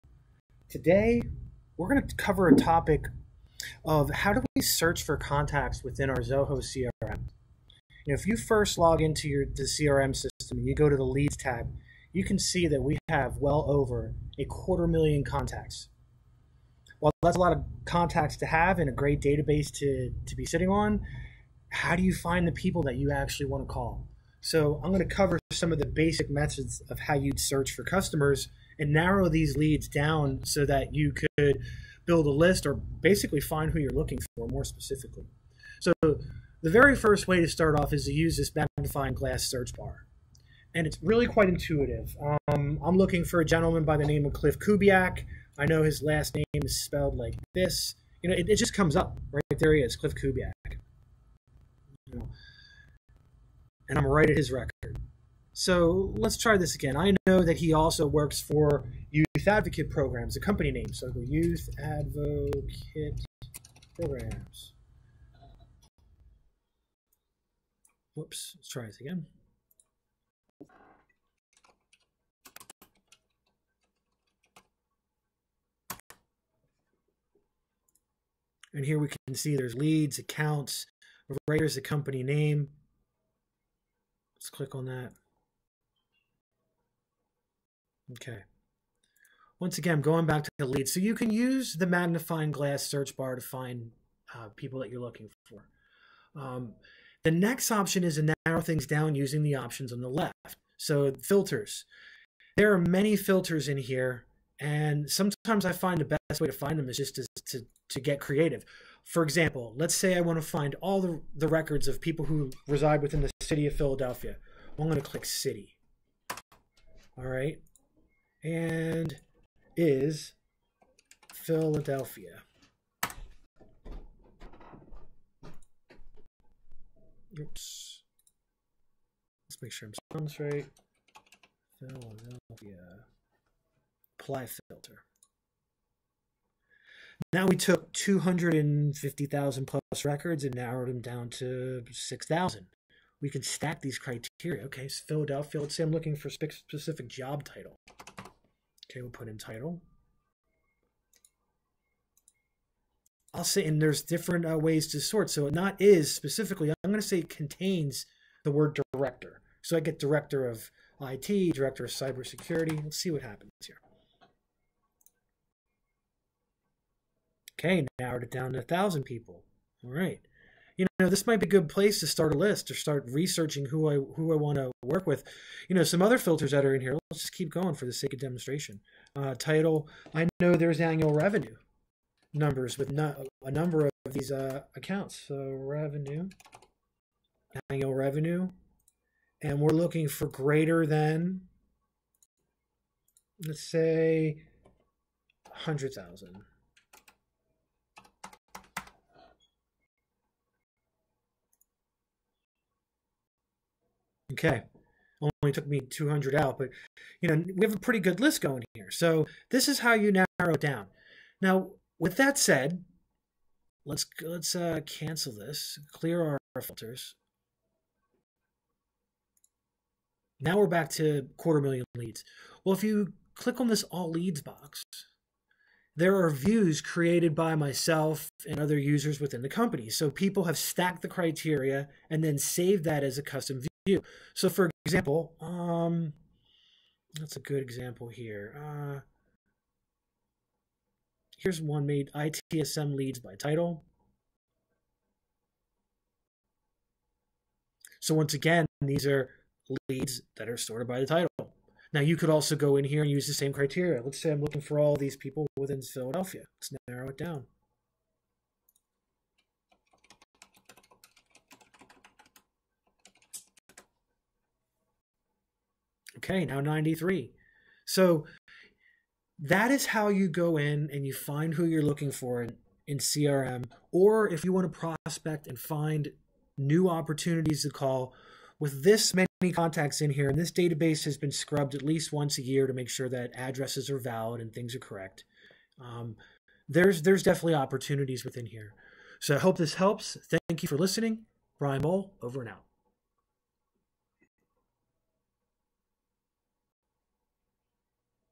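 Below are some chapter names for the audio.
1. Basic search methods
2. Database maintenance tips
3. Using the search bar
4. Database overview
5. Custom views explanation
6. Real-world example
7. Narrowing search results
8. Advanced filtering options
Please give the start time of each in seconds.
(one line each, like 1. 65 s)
1. 31 s
2. 285 s
3. 42 s
4. 14 s
5. 218 s
6. 257 s
7. 142 s
8. 96 s.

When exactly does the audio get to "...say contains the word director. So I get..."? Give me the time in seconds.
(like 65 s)
157 s.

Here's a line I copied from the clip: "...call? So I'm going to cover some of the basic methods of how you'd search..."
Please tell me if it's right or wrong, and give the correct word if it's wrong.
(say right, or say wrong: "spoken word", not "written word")
right.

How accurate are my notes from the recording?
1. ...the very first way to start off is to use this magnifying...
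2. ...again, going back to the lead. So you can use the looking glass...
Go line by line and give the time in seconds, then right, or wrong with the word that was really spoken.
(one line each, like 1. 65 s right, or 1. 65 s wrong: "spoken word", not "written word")
1. 36 s right
2. 89 s wrong: "magnifying", not "looking".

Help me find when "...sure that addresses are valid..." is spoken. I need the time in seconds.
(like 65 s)
282 s.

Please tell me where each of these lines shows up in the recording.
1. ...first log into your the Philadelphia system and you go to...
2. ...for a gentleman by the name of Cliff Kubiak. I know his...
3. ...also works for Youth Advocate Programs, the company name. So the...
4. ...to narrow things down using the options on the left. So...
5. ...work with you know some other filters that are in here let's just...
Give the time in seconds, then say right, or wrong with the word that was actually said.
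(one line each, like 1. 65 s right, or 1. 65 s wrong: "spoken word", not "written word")
1. 8 s wrong: "CRM", not "Philadelphia"
2. 43 s right
3. 57 s right
4. 98 s right
5. 174 s right.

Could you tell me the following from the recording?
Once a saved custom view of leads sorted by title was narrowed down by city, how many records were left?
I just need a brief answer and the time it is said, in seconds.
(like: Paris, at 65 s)
93, at 266 s.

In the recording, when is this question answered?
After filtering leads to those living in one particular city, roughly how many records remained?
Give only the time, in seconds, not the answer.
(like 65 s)
141 s.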